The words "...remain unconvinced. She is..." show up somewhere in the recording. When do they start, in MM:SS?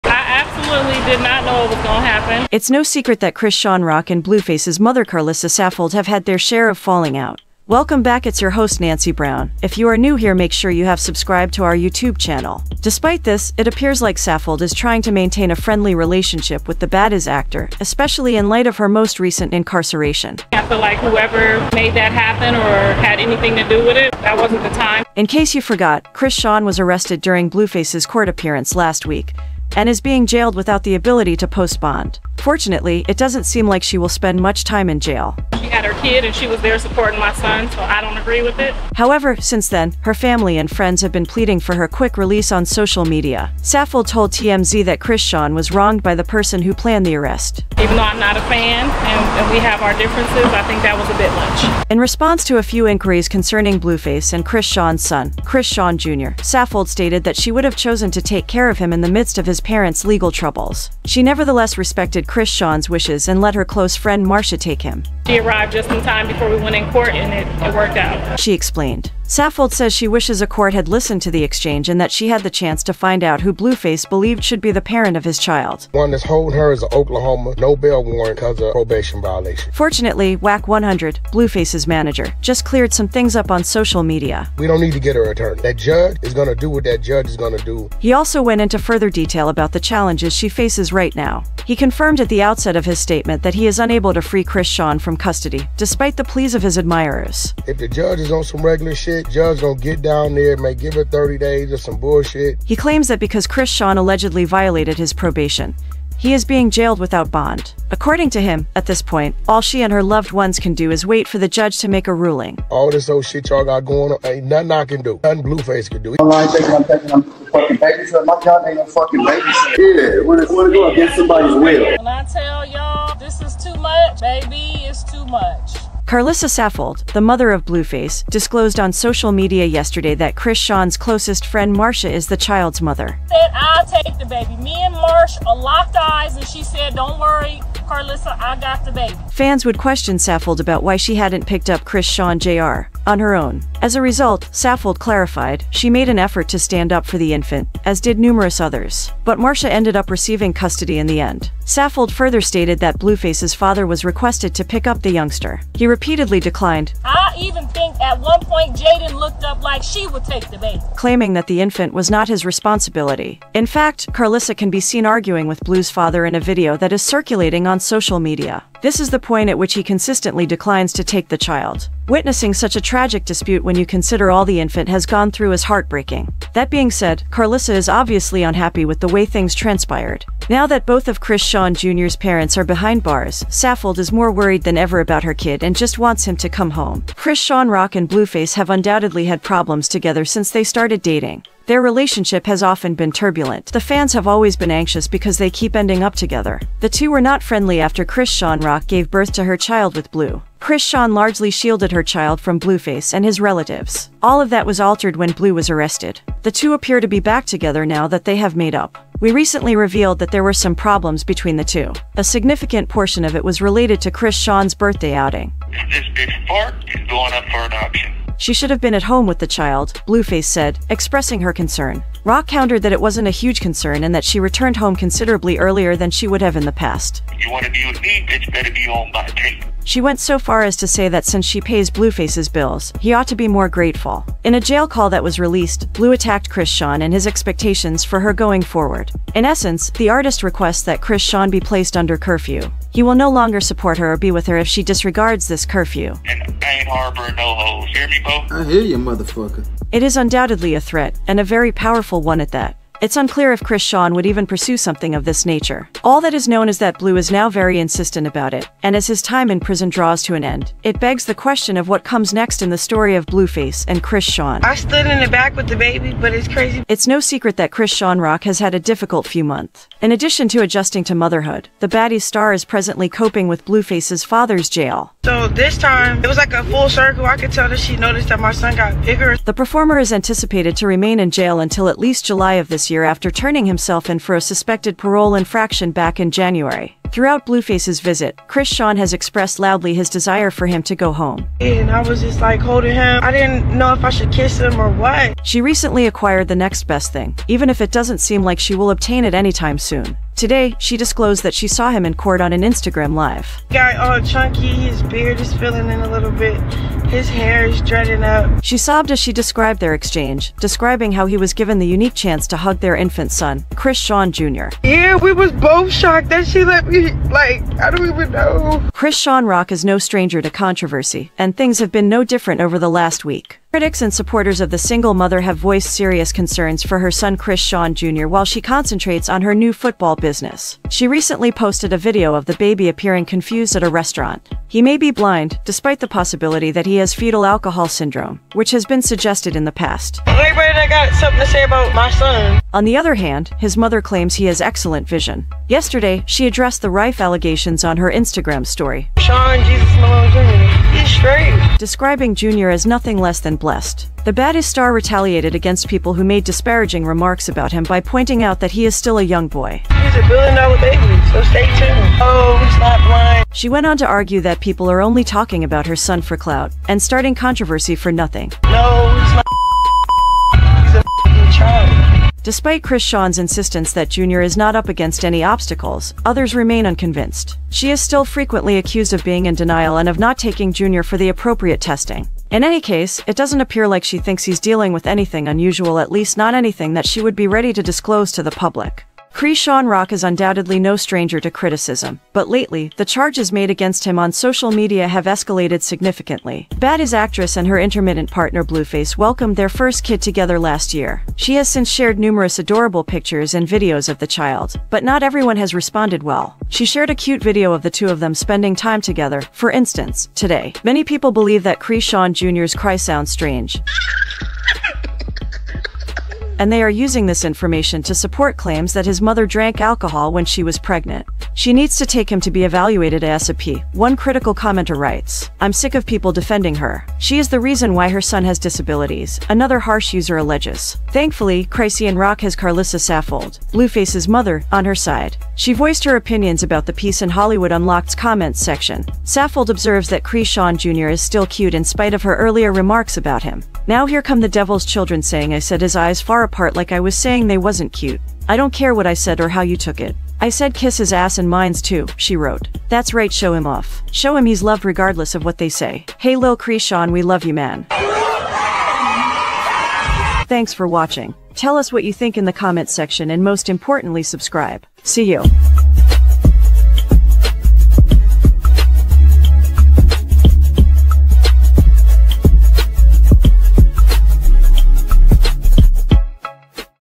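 06:16.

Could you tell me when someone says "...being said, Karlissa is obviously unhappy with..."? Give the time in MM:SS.
02:56.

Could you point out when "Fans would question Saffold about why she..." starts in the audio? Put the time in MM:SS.
02:19.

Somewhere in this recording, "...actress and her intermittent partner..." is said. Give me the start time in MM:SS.
06:37.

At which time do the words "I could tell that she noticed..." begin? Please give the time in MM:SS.
04:37.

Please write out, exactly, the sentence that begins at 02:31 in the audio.
Saffold further stated that Blueface's father was requested to pick up the youngster.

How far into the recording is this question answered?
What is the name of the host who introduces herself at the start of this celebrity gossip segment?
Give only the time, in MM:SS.
00:08.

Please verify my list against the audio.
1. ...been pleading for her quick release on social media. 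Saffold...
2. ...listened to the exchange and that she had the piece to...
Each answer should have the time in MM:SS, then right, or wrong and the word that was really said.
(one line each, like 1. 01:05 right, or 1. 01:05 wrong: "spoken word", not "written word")
1. 00:41 right
2. 01:10 wrong: "chance", not "piece".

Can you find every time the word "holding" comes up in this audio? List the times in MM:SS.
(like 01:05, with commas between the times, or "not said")
01:16, 04:52.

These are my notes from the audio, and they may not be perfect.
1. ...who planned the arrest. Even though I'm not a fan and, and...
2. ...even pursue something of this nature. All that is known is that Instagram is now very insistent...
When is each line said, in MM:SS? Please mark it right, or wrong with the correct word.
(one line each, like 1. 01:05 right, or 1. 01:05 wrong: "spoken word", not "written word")
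1. 00:46 right
2. 04:14 wrong: "Blue", not "Instagram".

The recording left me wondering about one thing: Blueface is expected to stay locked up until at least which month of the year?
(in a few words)
July.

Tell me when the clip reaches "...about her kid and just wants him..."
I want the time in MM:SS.
03:04.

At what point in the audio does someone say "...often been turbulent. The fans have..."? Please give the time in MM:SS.
03:12.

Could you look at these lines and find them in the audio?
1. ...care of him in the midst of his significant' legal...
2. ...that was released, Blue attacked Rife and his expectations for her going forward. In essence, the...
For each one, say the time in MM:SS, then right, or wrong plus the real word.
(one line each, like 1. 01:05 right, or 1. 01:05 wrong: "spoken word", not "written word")
1. 00:58 wrong: "parents", not "significant"
2. 03:55 wrong: "Chrisean", not "Rife".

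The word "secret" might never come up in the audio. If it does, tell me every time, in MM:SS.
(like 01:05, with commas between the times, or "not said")
00:02, 04:27.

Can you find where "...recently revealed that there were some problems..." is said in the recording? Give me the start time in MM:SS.
03:29.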